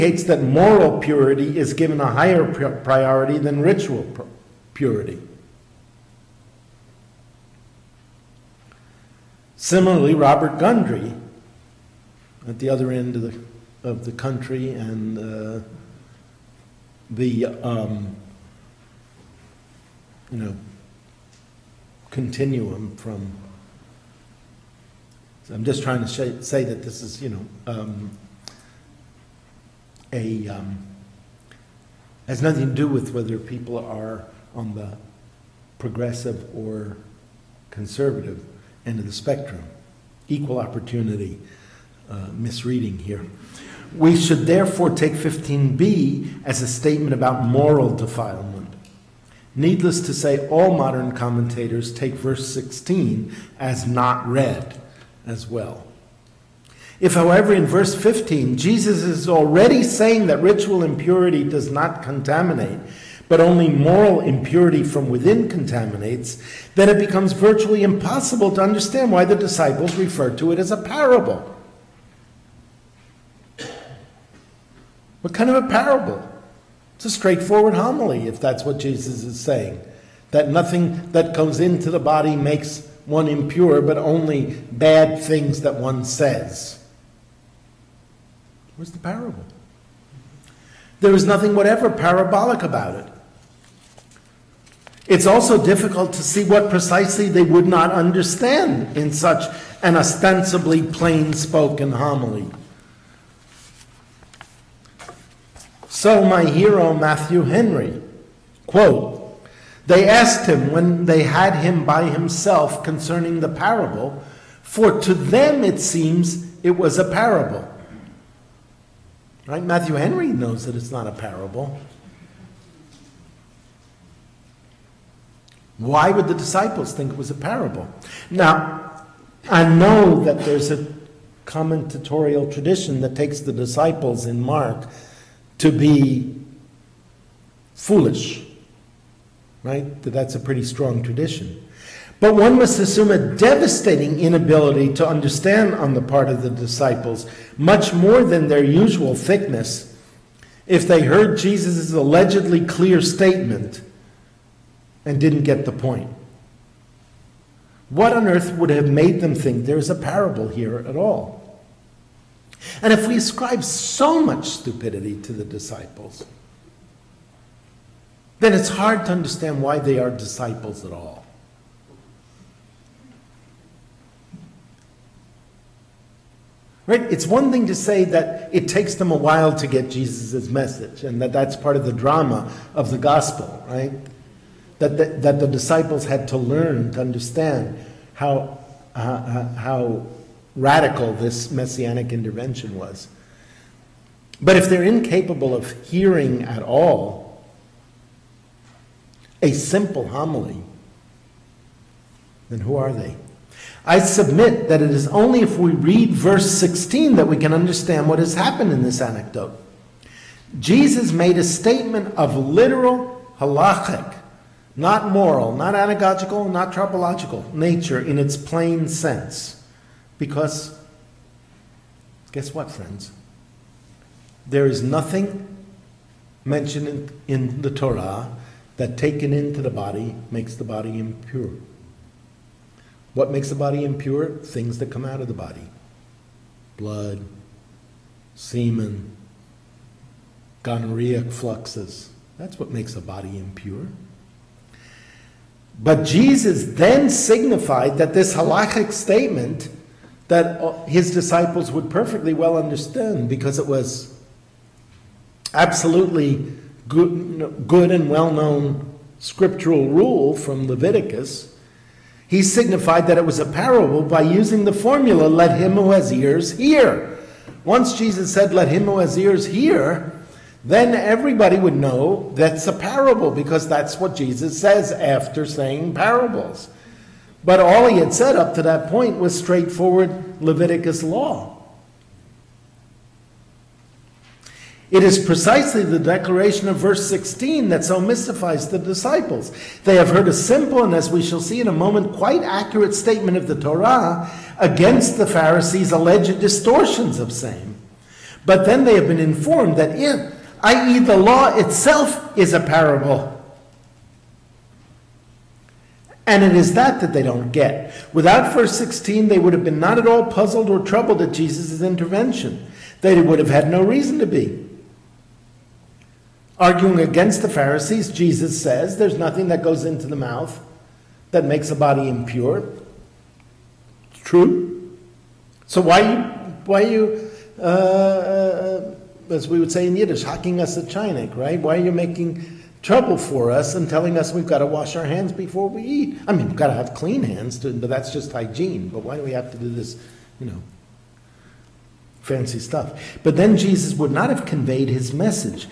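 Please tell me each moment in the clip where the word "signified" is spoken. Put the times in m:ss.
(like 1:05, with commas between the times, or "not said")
4:07, 4:22.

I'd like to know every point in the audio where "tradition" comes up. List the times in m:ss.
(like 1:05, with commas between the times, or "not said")
2:12, 2:21.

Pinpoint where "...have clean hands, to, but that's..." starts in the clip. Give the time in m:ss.
5:36.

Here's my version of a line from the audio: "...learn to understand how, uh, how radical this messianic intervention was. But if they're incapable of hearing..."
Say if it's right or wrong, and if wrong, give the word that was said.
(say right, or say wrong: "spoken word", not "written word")
right.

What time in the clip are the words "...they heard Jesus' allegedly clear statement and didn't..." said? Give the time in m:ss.
2:30.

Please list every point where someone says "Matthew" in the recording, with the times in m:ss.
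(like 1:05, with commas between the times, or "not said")
1:46, 1:59.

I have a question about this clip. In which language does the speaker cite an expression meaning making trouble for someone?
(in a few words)
Yiddish.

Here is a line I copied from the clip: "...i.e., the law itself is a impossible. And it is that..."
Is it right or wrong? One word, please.
wrong.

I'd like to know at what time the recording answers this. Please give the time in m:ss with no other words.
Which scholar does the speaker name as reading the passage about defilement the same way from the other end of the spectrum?
0:10.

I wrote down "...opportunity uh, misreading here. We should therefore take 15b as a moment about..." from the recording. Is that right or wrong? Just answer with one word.
wrong.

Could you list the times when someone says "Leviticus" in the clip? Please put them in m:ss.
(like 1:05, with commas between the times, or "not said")
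4:20, 4:40.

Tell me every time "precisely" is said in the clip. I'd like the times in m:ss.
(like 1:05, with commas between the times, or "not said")
1:36, 4:45.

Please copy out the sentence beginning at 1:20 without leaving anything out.
That nothing that comes into the body makes one impure, but only bad things that one says.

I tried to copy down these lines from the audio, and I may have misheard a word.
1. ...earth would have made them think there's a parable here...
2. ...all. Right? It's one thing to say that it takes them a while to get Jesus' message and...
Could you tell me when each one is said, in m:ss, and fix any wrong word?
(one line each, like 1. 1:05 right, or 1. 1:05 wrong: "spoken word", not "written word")
1. 2:38 right
2. 2:50 right.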